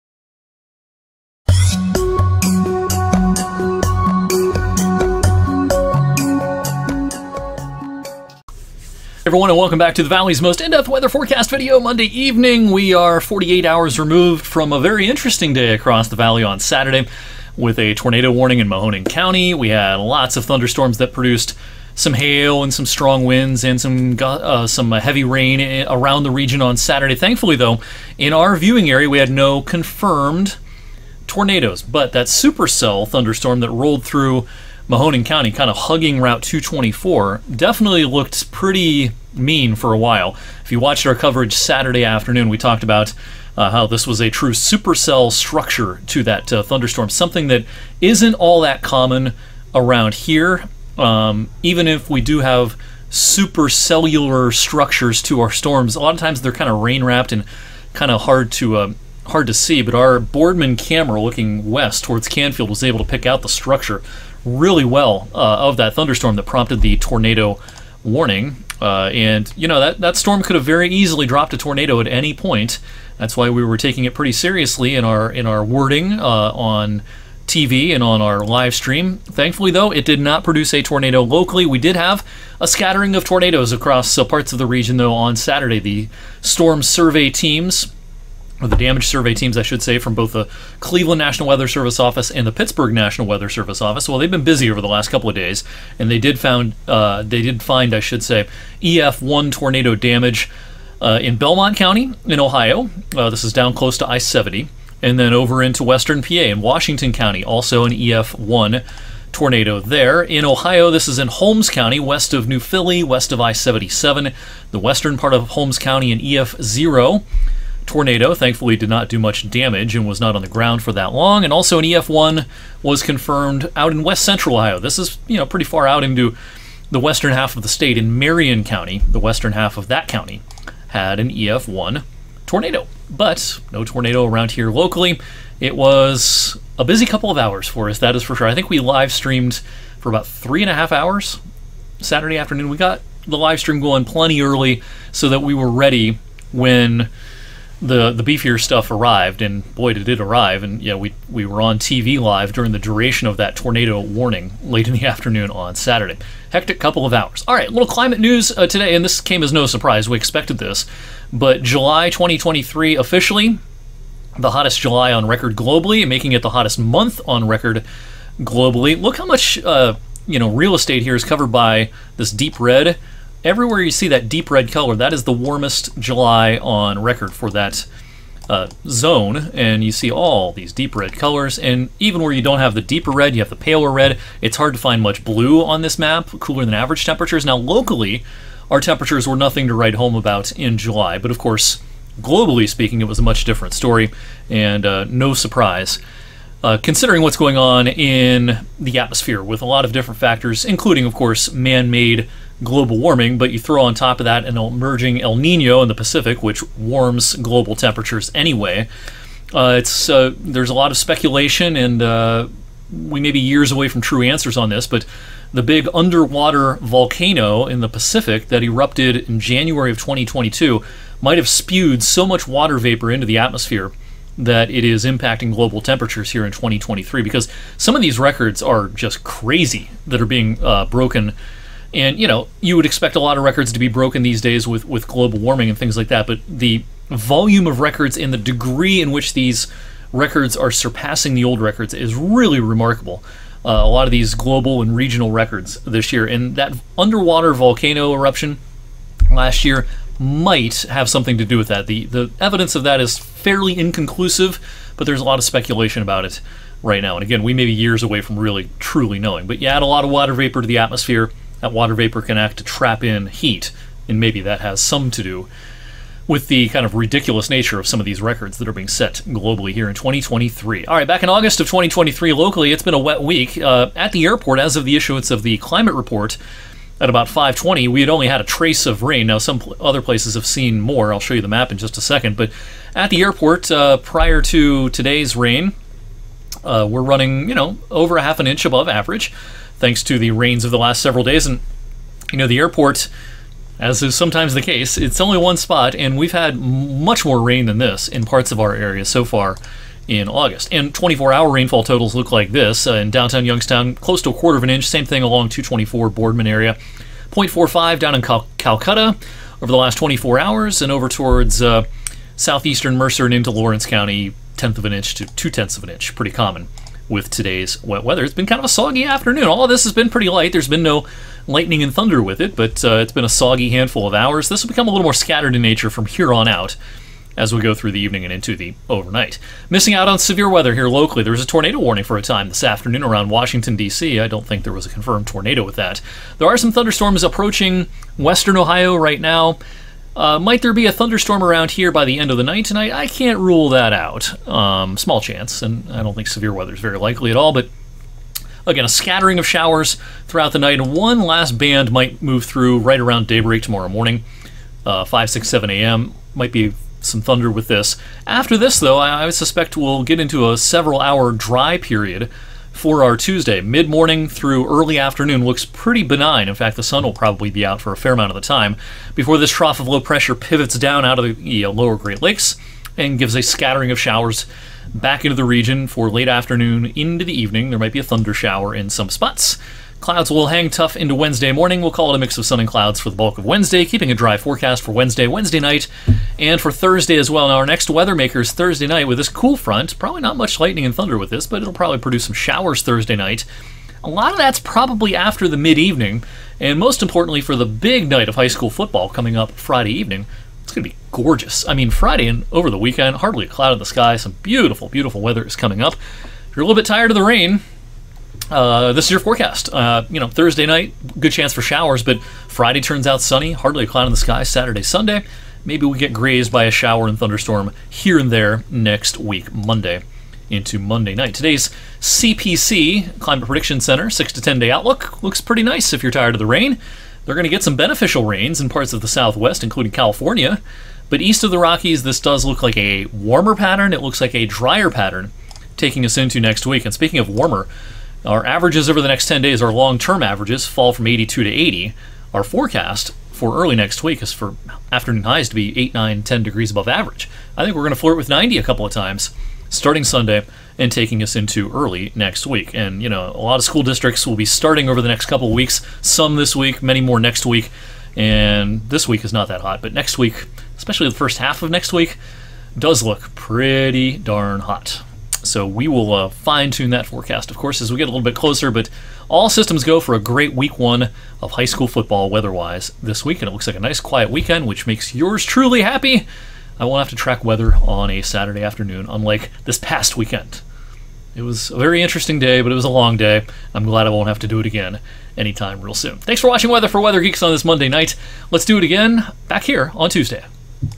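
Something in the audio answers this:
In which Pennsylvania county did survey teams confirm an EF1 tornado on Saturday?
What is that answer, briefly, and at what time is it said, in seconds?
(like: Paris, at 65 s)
Washington County, at 106 s.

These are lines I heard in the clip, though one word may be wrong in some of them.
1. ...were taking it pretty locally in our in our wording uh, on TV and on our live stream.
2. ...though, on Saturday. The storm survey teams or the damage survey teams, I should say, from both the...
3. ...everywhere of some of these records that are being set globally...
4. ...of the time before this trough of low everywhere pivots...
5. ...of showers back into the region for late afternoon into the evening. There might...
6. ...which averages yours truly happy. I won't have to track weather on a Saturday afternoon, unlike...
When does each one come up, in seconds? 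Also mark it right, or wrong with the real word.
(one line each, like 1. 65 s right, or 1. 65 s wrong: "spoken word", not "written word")
1. 73 s wrong: "seriously", not "locally"
2. 84 s right
3. 267 s wrong: "nature", not "everywhere"
4. 368 s wrong: "pressure", not "everywhere"
5. 373 s right
6. 474 s wrong: "makes", not "averages".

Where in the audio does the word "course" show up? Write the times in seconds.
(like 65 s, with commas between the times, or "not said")
191 s, 201 s, 467 s.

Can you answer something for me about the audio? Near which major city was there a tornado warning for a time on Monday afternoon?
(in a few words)
Washington, D.C.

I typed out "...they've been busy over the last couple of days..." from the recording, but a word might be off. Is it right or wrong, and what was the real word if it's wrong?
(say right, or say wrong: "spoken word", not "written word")
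right.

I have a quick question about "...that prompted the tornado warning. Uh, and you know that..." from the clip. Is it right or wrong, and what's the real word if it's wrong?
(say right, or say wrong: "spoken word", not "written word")
right.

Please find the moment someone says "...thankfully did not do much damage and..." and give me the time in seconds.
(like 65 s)
118 s.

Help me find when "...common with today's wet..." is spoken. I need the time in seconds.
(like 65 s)
316 s.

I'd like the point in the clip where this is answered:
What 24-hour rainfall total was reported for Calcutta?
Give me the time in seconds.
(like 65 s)
307 s.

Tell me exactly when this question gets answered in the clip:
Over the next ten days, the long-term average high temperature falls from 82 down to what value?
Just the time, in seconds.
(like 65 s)
441 s.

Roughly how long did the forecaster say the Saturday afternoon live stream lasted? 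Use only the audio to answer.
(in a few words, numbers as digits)
three and a half hours.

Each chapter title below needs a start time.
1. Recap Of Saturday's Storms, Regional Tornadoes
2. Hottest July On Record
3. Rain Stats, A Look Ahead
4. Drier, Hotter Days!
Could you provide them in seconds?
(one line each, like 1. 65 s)
1. 30 s
2. 136 s
3. 260 s
4. 410 s.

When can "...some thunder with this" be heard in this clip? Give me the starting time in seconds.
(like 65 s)
357 s.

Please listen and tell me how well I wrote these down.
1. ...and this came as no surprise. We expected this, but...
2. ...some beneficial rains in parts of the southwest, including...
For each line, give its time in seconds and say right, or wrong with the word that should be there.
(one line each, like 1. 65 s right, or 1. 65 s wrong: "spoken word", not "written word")
1. 158 s right
2. 427 s right.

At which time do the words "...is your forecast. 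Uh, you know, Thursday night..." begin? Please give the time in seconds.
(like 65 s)
409 s.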